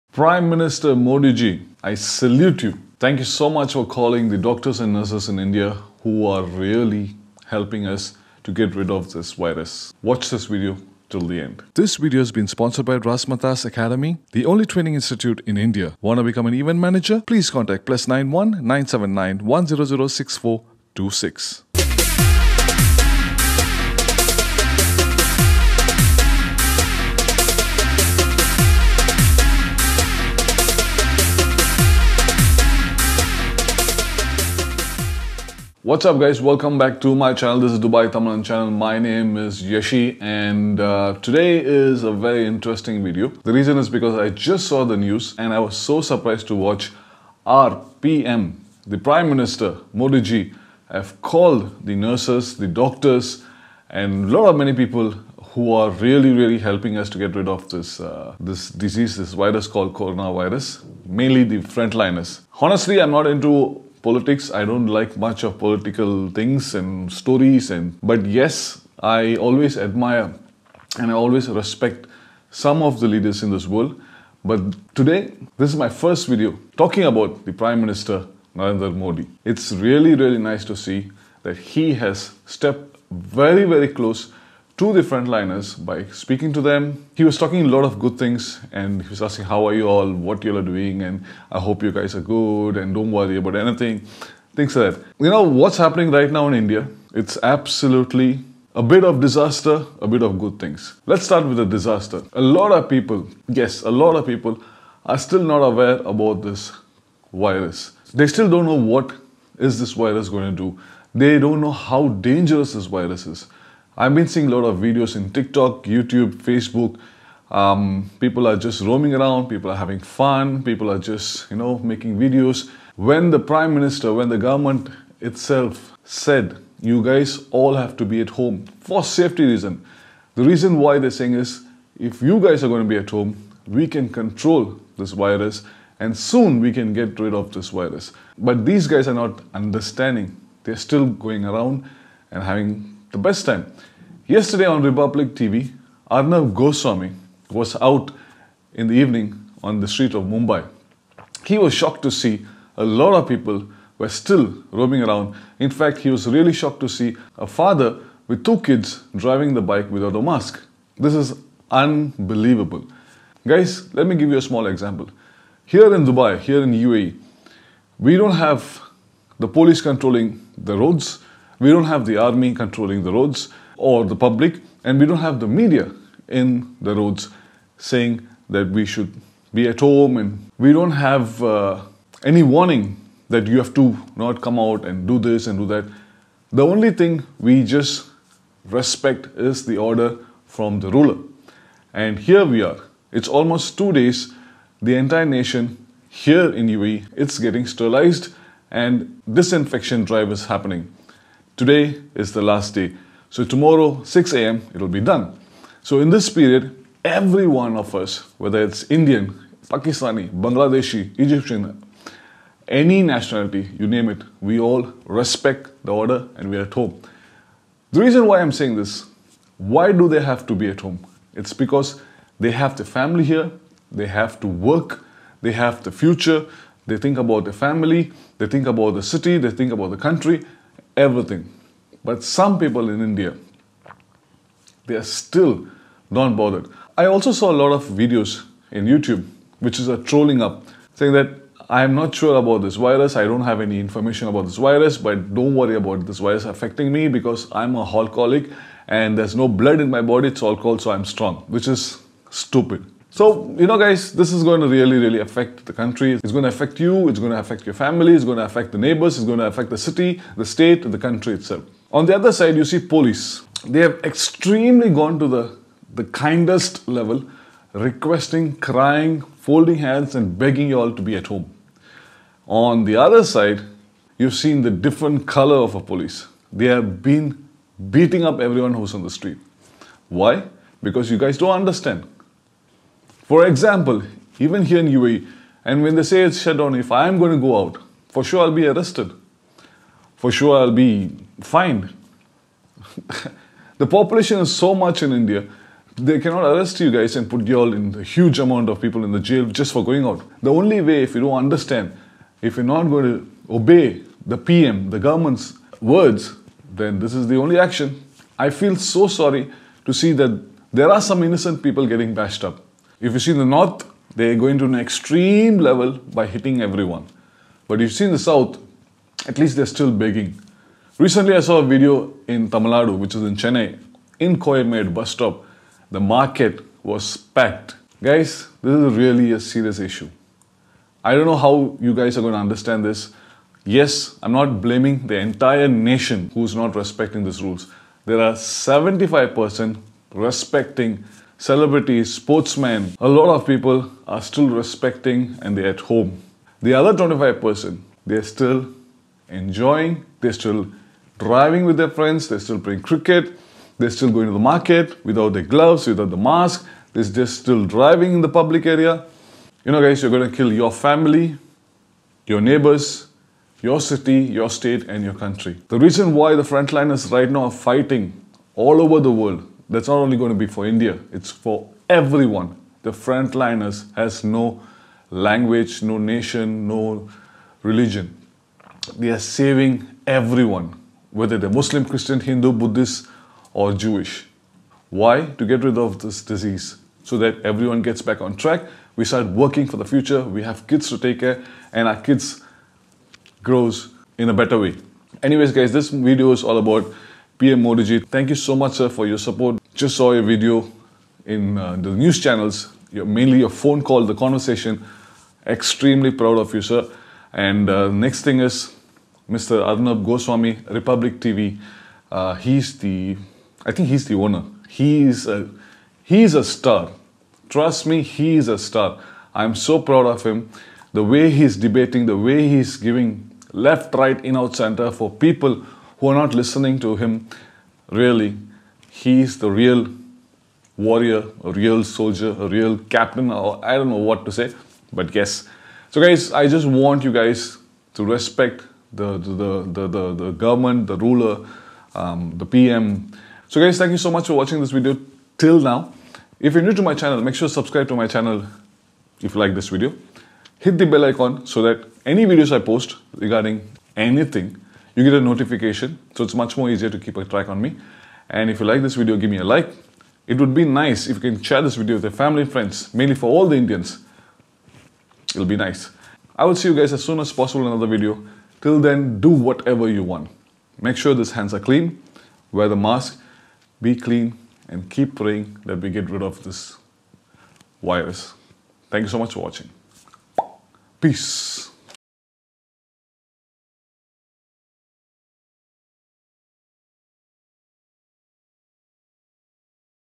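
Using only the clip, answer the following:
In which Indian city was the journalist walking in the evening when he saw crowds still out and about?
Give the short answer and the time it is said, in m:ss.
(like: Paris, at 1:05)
Mumbai, at 2:30.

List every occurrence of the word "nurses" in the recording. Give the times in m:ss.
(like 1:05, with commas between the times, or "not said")
0:04, 0:51.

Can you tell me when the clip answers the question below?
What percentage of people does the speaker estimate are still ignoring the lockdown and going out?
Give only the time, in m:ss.
5:46.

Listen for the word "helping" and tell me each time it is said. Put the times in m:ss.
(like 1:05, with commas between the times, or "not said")
0:07, 0:56.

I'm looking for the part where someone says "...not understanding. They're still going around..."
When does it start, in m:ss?
2:19.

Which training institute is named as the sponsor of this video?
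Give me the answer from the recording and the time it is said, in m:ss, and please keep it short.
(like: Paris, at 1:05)
Rasmatas Academy, at 0:12.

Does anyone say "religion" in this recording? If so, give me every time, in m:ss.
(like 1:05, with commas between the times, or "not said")
6:17.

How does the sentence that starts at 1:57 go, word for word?
Um, people are just roaming around, people are having fun, people are just, you know, making videos.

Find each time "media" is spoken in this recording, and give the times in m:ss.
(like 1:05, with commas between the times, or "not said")
2:55.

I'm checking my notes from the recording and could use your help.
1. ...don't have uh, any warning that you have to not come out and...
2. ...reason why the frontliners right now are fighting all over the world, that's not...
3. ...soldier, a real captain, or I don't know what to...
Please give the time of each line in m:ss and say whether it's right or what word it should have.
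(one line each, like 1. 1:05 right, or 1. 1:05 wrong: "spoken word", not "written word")
1. 3:00 right
2. 6:05 right
3. 7:11 right.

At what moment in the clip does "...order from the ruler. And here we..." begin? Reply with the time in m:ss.
3:09.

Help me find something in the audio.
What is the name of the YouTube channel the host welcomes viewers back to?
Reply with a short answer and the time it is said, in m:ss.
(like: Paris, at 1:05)
Dubai Tamizhan, at 0:37.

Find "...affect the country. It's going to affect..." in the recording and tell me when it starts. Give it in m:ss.
4:15.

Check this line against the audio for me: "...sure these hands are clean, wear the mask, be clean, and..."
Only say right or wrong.
right.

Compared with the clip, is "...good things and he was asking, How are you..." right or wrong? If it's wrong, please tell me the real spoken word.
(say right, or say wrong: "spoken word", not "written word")
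right.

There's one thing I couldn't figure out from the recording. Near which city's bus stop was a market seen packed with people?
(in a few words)
Coimbatore.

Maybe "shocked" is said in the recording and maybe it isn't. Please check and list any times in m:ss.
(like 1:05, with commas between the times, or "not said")
2:31, 2:36.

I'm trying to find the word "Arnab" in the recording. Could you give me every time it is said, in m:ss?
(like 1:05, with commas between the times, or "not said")
2:26, 6:49.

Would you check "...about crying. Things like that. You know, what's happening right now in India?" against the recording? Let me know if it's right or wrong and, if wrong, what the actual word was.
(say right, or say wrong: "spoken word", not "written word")
wrong: "anything", not "crying".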